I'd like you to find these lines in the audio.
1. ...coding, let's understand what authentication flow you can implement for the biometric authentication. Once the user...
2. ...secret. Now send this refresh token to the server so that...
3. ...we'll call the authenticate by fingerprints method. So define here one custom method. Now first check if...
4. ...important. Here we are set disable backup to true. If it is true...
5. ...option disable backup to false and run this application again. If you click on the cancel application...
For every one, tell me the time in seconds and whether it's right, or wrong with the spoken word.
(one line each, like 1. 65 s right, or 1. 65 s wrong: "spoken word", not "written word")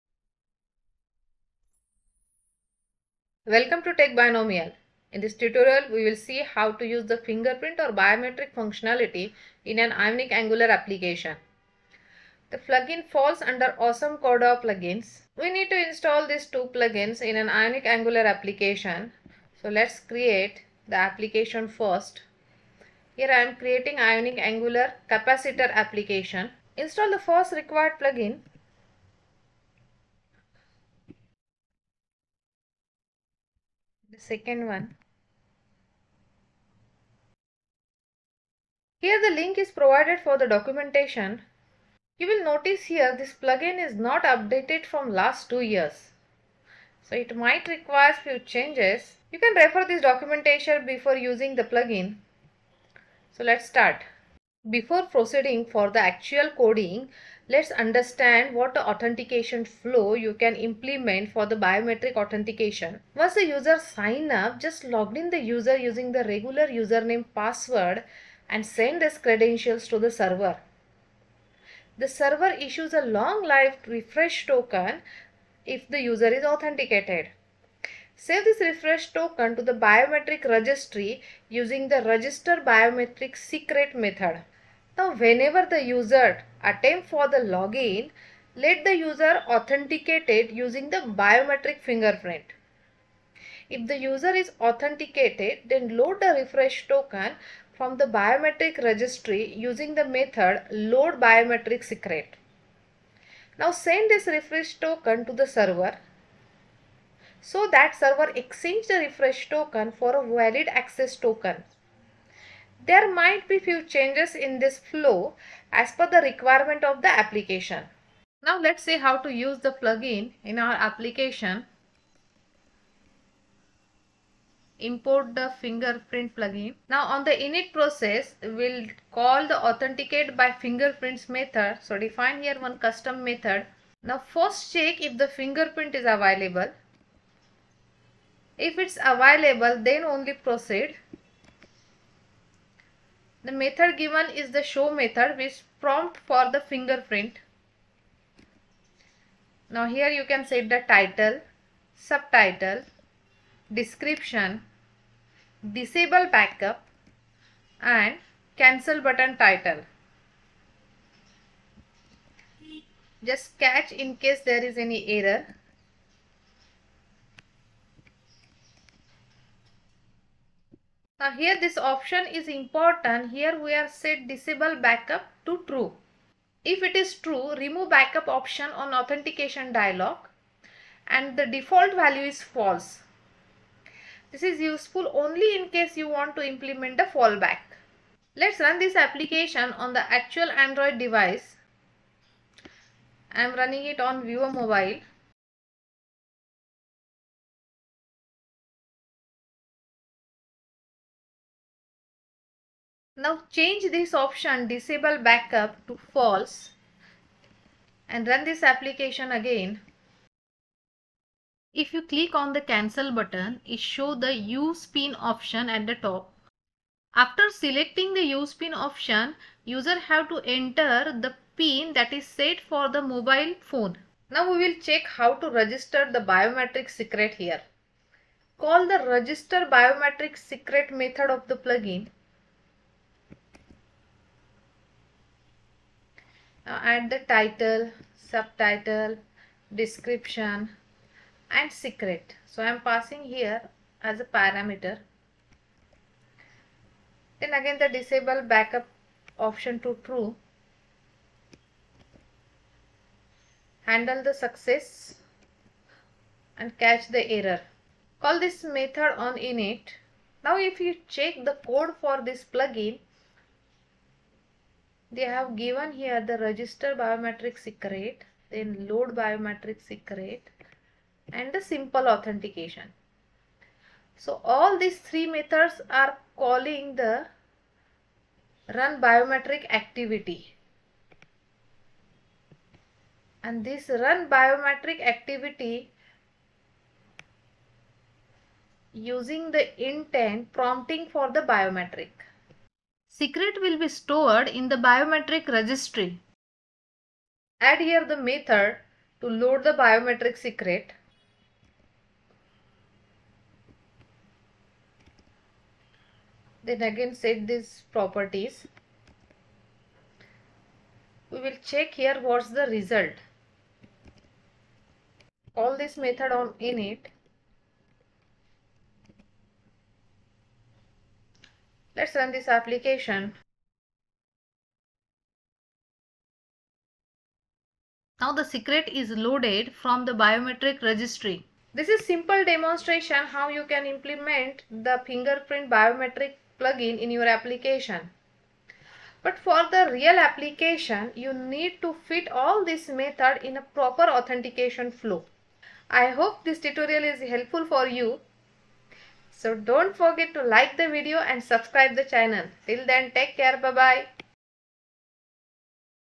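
1. 56 s right
2. 101 s right
3. 128 s right
4. 172 s right
5. 204 s wrong: "button", not "application".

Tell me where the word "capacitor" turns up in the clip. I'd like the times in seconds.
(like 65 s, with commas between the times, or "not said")
25 s.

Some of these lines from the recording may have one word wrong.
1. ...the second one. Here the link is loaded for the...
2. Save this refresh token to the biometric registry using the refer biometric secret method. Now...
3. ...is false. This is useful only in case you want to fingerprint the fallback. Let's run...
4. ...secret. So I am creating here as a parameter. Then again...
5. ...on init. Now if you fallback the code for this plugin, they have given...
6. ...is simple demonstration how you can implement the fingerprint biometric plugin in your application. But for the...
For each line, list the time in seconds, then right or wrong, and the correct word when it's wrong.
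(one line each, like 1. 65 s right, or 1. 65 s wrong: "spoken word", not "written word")
1. 34 s wrong: "provided", not "loaded"
2. 78 s wrong: "register", not "refer"
3. 182 s wrong: "implement", not "fingerprint"
4. 241 s wrong: "passing", not "creating"
5. 259 s wrong: "check", not "fallback"
6. 331 s right.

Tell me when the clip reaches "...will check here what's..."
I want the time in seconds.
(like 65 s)
311 s.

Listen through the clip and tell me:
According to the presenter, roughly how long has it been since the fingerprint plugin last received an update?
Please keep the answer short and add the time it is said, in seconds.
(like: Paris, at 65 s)
2 years, at 45 s.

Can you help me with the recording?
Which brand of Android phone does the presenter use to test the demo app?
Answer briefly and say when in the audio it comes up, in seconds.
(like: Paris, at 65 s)
Viewer Mobile, at 194 s.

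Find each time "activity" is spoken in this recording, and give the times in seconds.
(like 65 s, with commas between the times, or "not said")
279 s, 285 s.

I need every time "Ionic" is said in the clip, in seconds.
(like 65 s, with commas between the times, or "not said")
9 s, 17 s, 23 s.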